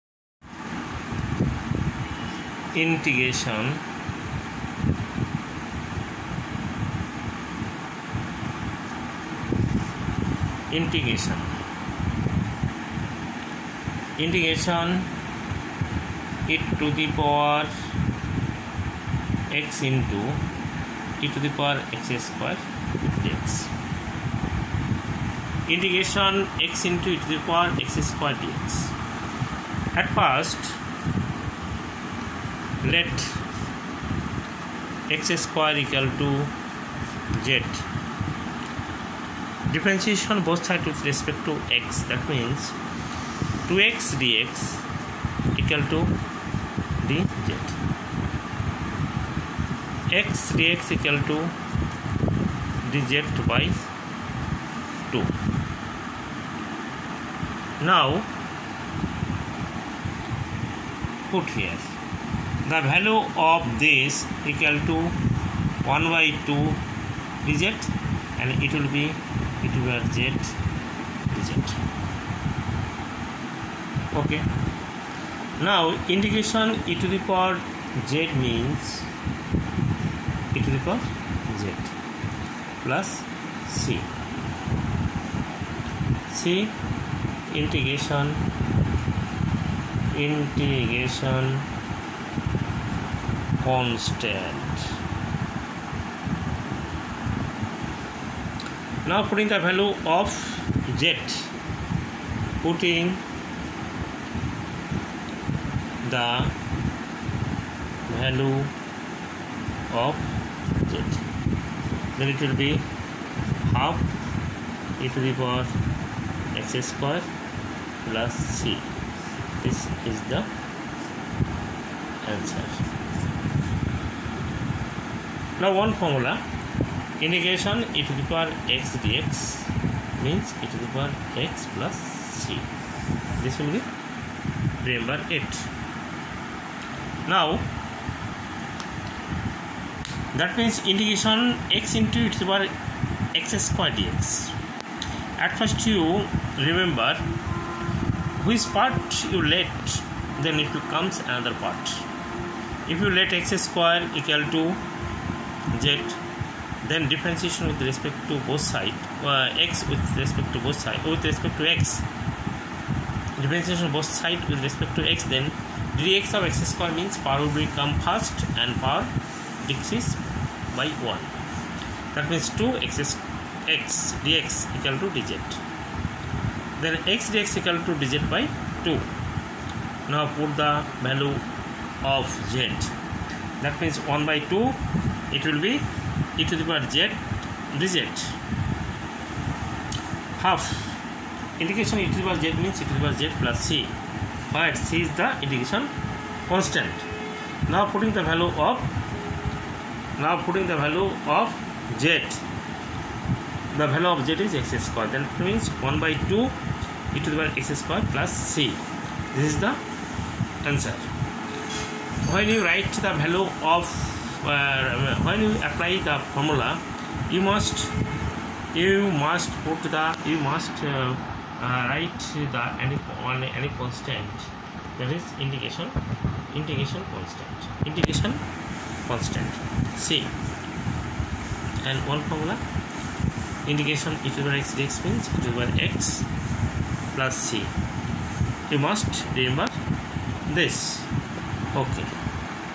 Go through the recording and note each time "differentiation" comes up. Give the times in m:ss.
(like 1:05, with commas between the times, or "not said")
0:39, 2:37, 2:43.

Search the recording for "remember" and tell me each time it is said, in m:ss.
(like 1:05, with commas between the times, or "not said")
2:14, 2:26, 3:59.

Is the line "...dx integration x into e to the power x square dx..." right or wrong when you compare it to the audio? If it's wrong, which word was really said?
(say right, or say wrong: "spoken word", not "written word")
right.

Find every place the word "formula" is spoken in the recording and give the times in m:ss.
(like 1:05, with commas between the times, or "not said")
2:05, 3:36, 3:52.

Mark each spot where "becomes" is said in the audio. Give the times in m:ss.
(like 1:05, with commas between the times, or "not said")
2:30, 2:47.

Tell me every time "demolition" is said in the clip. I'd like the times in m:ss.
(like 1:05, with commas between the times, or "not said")
not said.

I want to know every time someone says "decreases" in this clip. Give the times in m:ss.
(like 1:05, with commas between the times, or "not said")
2:49.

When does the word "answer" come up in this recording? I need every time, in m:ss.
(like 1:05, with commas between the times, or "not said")
2:02, 3:30.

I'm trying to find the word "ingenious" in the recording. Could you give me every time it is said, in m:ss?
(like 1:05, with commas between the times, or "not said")
not said.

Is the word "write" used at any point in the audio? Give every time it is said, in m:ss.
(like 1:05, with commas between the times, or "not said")
3:32, 3:41.